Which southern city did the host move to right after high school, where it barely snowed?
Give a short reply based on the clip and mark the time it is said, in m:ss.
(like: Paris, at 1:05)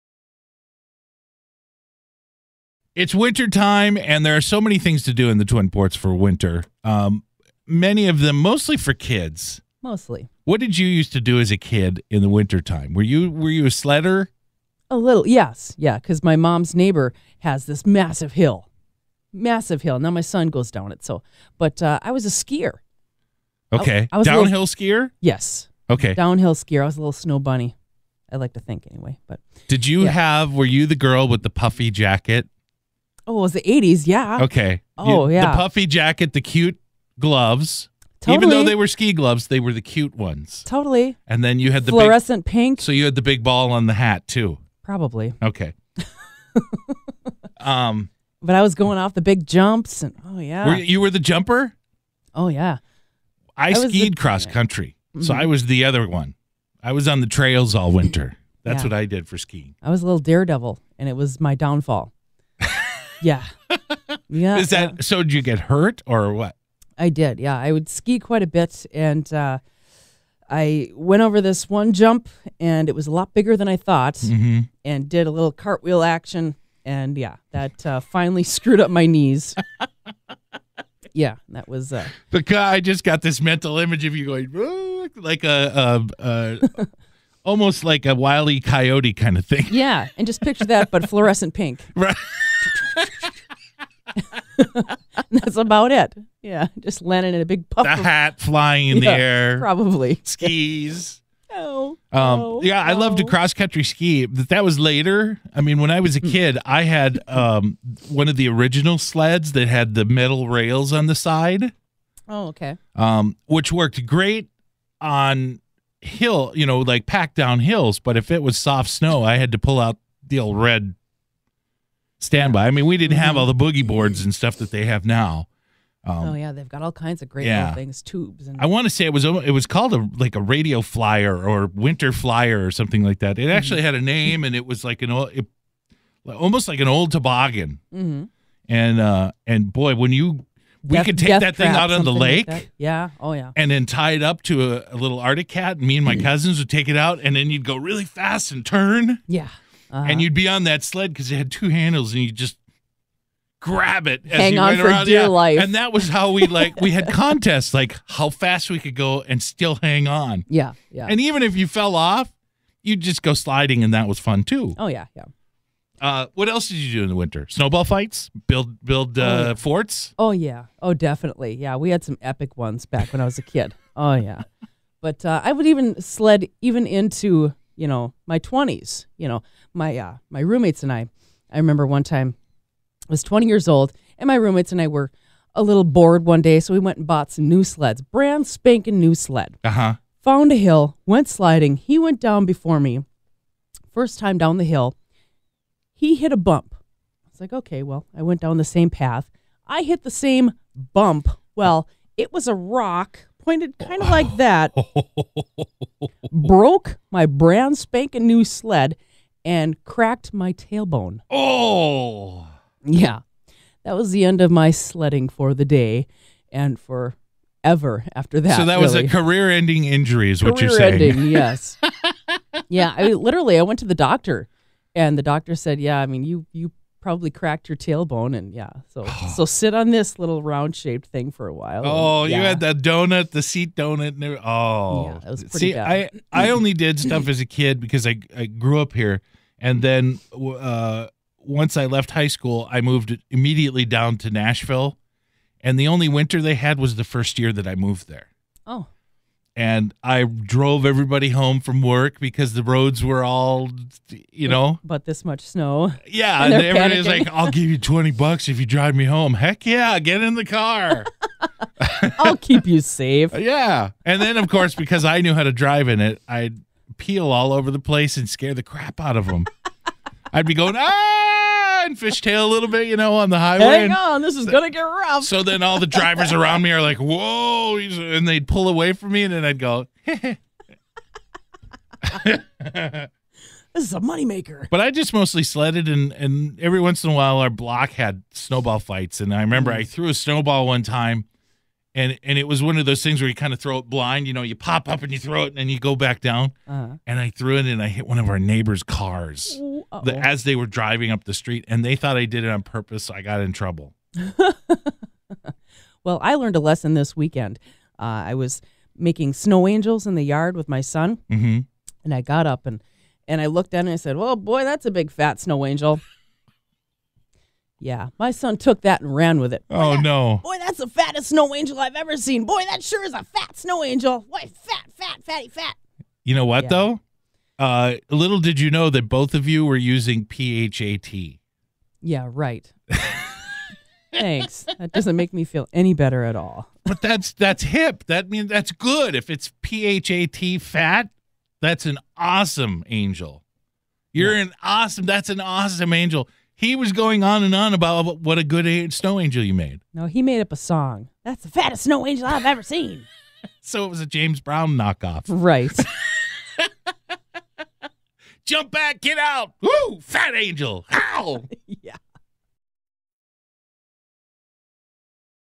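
Nashville, at 4:04.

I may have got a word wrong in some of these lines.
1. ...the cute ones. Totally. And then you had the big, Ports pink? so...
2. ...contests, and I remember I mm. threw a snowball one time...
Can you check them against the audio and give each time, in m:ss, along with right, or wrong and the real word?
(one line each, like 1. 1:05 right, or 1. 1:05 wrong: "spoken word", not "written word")
1. 0:39 wrong: "Fluorescent", not "Ports"
2. 4:48 wrong: "fights", not "contests".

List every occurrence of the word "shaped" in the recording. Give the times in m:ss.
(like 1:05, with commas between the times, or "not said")
3:50.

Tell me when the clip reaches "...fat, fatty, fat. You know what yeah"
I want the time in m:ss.
5:24.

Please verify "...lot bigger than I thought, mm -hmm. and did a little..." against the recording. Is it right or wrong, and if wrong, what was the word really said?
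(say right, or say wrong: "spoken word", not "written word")
right.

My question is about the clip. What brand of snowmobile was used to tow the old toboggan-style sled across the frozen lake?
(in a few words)
Arctic Cat.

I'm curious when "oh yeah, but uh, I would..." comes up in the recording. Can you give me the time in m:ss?
2:53.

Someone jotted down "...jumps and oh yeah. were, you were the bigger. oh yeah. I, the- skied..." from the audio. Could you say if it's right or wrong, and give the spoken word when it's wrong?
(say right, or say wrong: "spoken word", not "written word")
wrong: "jumper", not "bigger".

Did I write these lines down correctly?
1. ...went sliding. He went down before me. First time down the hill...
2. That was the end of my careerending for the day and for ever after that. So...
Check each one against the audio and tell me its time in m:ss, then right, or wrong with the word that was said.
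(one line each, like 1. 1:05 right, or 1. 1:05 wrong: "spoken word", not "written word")
1. 3:11 right
2. 3:33 wrong: "sledding", not "careerending".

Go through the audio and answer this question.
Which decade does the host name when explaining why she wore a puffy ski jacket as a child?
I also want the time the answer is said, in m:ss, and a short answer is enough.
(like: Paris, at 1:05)
the 80s, at 0:33.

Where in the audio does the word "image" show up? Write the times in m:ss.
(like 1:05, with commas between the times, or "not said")
1:23.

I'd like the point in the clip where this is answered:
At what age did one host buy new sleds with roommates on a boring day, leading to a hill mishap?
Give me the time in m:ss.
3:03.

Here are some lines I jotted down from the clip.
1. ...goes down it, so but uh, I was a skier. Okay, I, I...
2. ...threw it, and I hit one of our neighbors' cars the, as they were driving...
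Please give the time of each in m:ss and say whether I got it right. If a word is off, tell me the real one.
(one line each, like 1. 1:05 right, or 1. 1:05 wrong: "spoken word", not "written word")
1. 0:20 right
2. 4:57 right.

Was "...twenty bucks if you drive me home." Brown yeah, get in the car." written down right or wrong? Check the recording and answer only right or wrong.
wrong.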